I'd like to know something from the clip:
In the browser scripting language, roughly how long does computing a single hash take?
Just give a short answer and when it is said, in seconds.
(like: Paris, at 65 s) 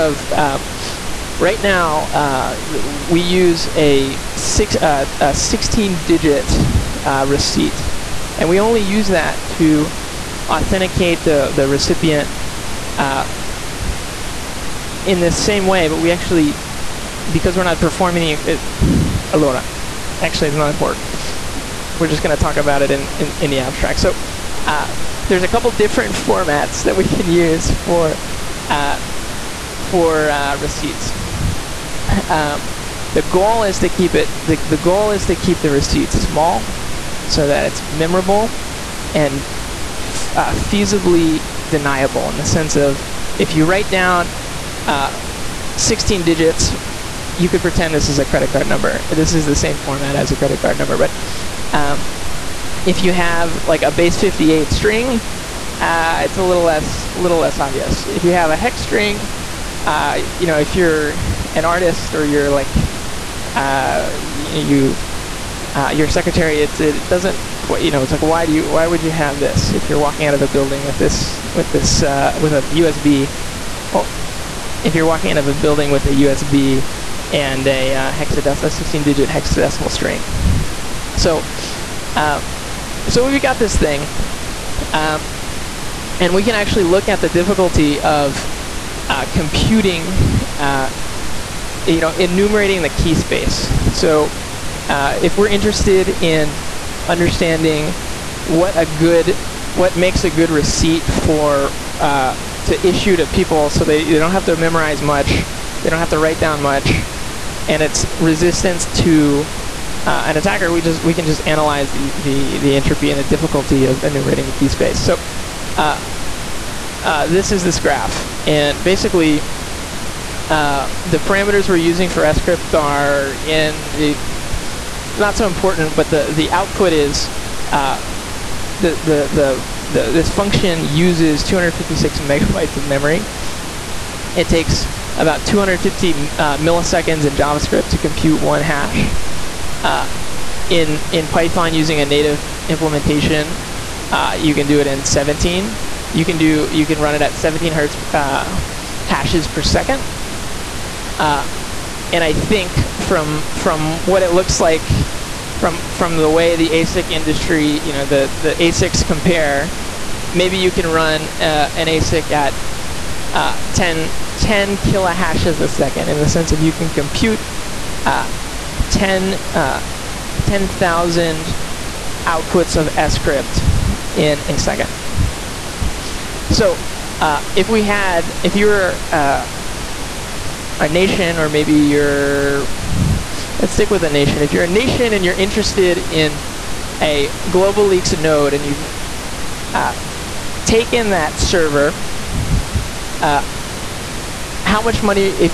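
250 milliseconds, at 135 s.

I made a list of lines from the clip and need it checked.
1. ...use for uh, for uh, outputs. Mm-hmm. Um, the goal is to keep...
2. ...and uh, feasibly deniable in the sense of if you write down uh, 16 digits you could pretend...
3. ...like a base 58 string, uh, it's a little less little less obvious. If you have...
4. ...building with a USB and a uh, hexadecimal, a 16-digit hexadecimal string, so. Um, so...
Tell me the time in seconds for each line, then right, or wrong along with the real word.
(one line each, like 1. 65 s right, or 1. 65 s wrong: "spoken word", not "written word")
1. 27 s wrong: "receipts", not "outputs"
2. 39 s right
3. 53 s right
4. 75 s right.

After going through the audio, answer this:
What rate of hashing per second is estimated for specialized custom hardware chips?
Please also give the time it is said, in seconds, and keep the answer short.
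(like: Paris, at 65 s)
10,000, at 170 s.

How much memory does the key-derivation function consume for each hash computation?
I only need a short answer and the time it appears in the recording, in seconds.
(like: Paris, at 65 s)
256 megabytes, at 131 s.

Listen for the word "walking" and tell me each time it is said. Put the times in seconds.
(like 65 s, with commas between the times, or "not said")
69 s, 75 s.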